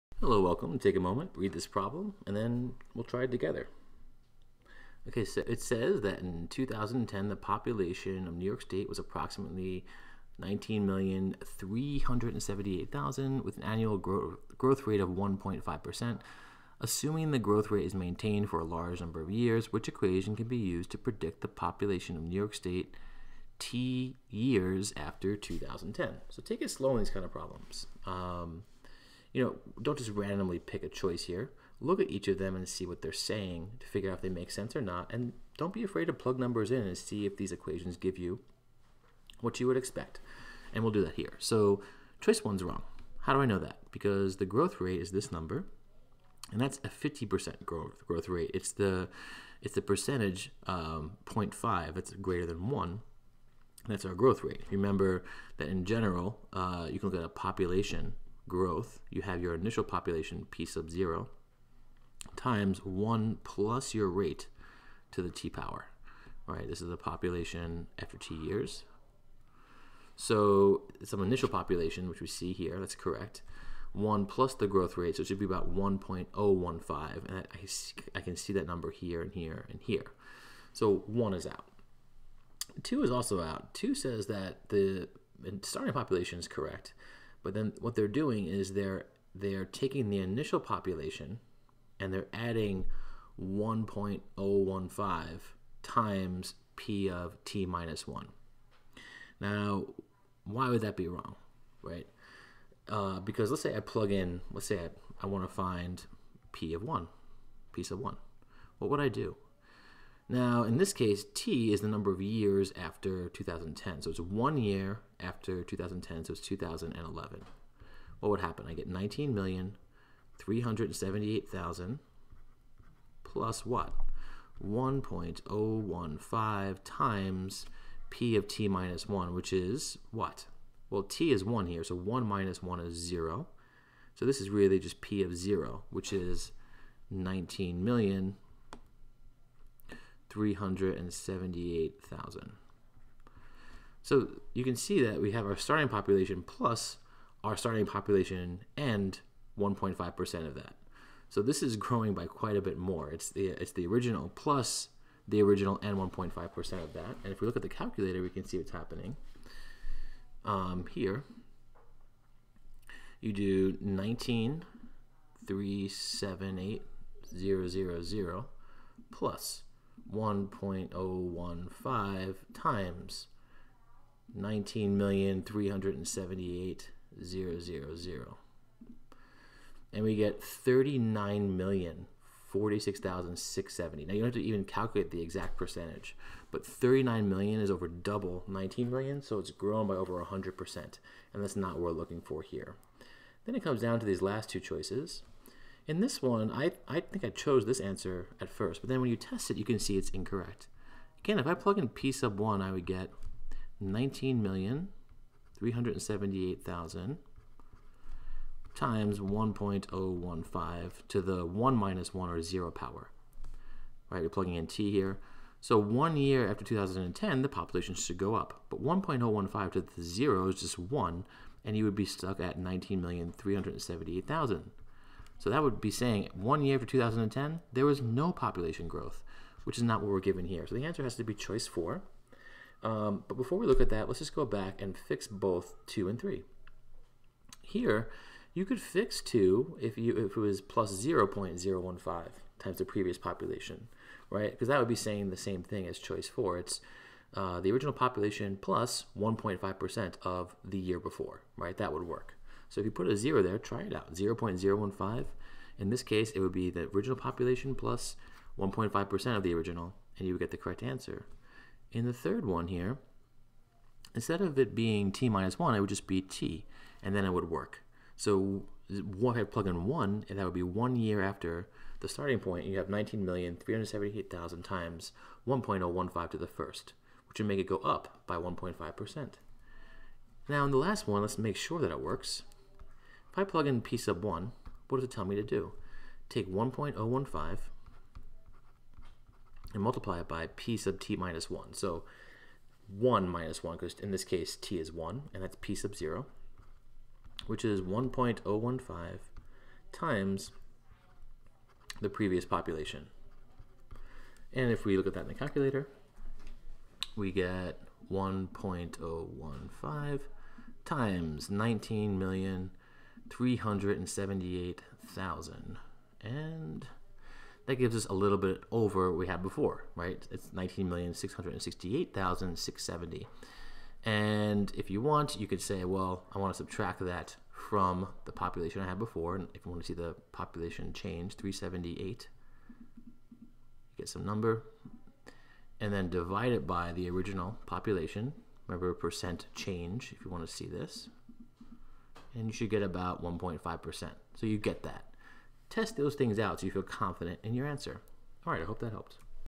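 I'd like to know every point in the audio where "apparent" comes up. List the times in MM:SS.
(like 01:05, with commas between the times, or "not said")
not said.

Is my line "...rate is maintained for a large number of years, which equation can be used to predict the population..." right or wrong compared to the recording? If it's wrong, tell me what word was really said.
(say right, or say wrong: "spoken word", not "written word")
right.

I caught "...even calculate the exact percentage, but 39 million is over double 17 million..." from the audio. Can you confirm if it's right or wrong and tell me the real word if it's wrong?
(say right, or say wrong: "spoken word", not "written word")
wrong: "19", not "17".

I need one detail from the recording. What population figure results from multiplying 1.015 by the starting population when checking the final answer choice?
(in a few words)
19,668,670.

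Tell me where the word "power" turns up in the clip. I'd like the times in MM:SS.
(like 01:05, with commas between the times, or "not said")
01:05, 03:32.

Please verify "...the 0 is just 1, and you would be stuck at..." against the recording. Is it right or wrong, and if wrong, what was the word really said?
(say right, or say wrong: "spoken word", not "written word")
right.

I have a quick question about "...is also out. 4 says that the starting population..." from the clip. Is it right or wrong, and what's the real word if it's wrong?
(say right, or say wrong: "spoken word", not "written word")
wrong: "2", not "4".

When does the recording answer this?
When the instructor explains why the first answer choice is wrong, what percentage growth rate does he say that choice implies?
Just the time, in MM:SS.
00:46.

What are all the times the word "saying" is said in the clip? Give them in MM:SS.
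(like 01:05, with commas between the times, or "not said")
00:33, 03:45, 04:04.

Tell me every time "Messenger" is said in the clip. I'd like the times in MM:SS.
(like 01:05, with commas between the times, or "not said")
not said.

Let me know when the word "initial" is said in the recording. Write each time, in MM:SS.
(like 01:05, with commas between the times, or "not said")
00:59, 01:11, 01:30.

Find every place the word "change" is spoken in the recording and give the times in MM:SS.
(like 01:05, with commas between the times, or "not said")
05:30, 05:39.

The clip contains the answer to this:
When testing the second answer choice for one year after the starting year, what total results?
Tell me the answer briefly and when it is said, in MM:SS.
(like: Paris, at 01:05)
39,046,670, at 03:00.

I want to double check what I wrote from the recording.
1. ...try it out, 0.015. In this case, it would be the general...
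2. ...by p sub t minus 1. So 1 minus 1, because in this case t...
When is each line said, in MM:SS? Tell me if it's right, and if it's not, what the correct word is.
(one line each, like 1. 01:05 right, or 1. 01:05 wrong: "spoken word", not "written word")
1. 04:13 wrong: "original", not "general"
2. 04:50 right.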